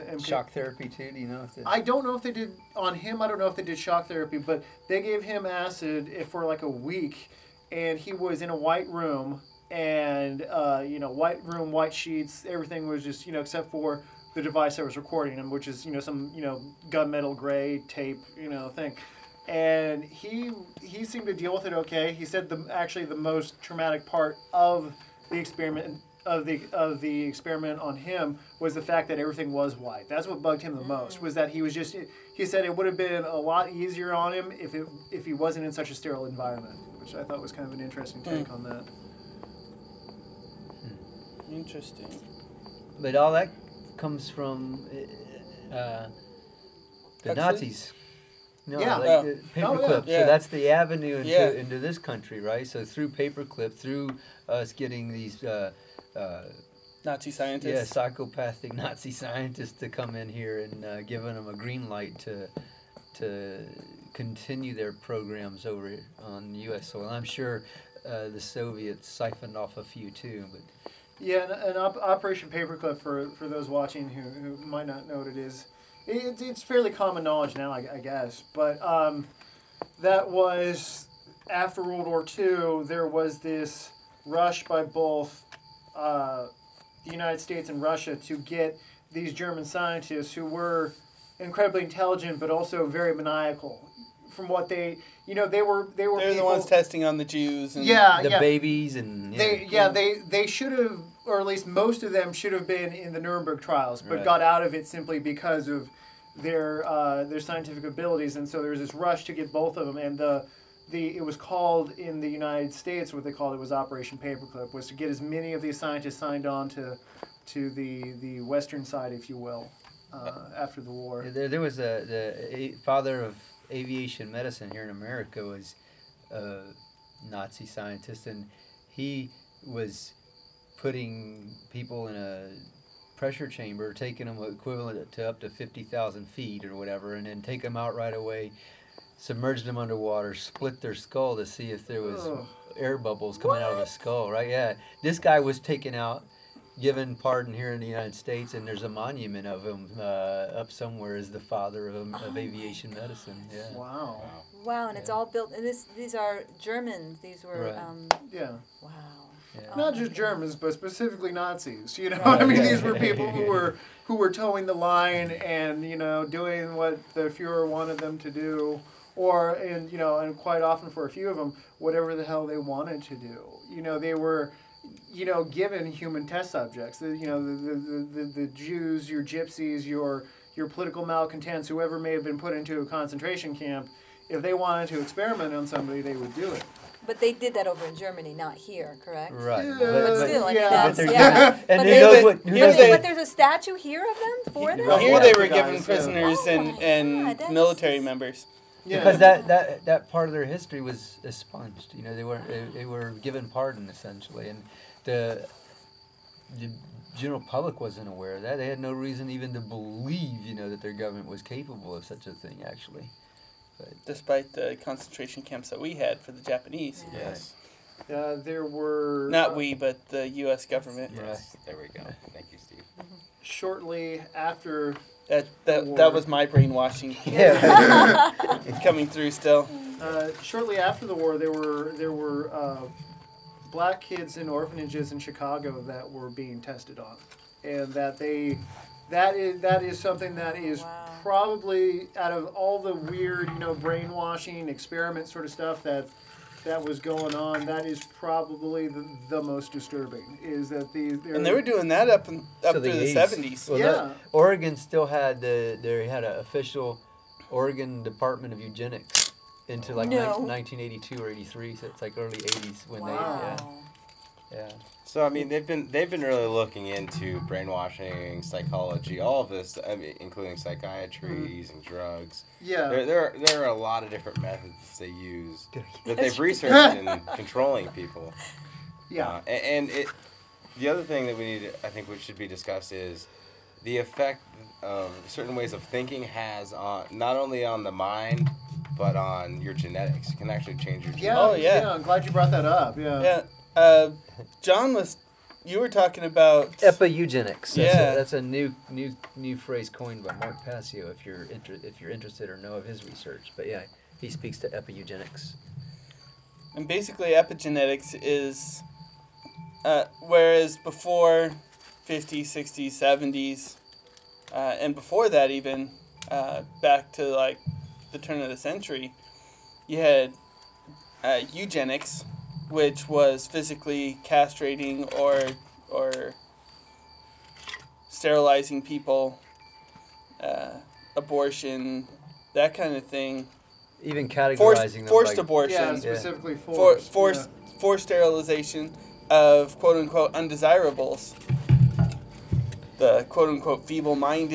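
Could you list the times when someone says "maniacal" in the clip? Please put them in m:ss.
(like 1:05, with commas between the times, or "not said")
1:33.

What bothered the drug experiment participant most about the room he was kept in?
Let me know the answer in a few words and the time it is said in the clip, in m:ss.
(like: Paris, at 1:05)
Everything was white, at 0:29.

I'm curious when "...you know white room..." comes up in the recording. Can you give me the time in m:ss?
0:10.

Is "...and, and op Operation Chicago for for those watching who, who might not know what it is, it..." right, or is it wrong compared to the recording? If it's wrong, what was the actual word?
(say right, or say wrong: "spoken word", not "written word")
wrong: "Paperclip", not "Chicago".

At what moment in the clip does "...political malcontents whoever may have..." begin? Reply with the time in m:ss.
3:00.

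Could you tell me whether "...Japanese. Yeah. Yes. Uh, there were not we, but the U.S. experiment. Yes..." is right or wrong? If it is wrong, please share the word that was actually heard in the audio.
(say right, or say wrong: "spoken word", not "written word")
wrong: "government", not "experiment".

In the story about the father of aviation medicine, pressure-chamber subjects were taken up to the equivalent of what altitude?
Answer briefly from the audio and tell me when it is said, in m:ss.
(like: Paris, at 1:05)
50,000 feet, at 2:15.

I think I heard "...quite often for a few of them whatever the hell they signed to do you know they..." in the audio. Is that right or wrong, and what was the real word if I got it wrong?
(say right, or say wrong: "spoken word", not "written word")
wrong: "wanted", not "signed".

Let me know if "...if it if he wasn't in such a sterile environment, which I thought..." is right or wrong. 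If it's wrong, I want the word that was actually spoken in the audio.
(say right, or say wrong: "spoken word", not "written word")
right.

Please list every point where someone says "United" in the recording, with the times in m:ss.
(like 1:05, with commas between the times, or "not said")
1:27, 1:52, 2:27.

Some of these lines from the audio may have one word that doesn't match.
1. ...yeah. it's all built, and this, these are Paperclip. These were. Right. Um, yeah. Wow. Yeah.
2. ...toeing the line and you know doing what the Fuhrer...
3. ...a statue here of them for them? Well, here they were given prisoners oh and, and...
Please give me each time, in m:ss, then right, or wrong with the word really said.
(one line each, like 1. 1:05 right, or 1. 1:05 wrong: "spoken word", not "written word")
1. 2:34 wrong: "Germans", not "Paperclip"
2. 2:44 right
3. 3:13 right.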